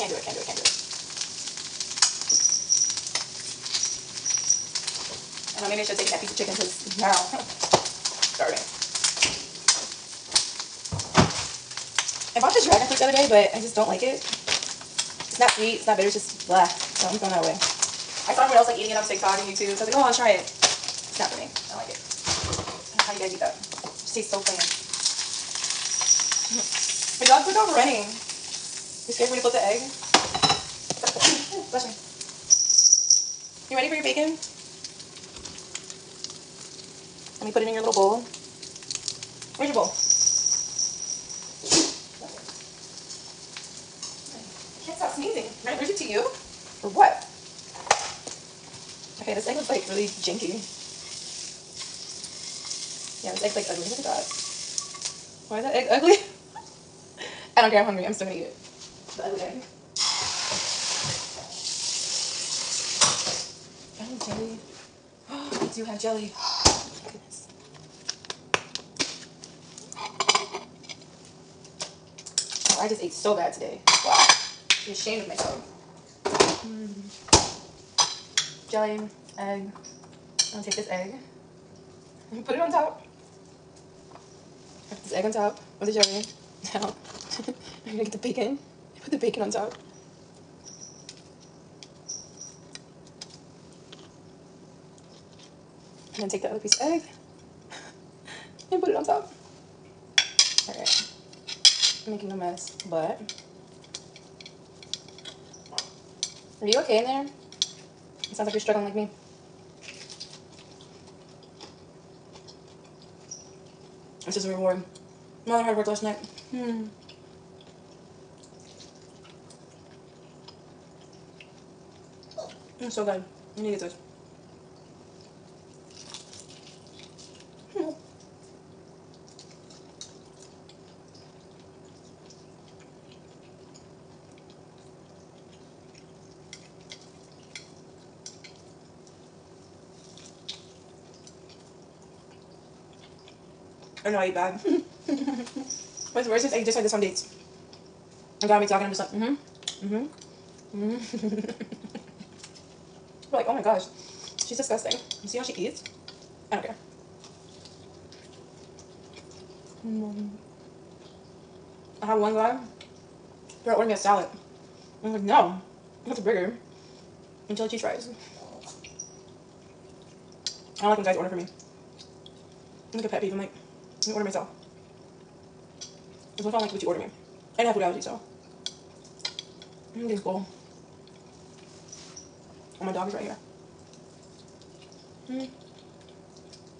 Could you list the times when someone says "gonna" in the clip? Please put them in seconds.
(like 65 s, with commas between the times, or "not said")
58 s, 80 s, 87 s, 148 s.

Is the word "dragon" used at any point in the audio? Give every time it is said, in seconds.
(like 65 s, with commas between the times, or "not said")
12 s.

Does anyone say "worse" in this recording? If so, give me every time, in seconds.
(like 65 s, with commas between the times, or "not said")
146 s.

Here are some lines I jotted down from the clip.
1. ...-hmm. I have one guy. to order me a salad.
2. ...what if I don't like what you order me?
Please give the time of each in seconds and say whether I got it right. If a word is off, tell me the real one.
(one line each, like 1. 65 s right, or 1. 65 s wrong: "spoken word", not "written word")
1. 160 s right
2. 176 s right.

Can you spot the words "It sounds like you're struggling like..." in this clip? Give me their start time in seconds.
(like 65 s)
108 s.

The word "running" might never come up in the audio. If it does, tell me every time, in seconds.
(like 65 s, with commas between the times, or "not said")
27 s.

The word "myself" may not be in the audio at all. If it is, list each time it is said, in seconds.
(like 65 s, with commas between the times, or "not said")
75 s, 174 s.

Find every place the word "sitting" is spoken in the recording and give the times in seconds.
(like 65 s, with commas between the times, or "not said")
not said.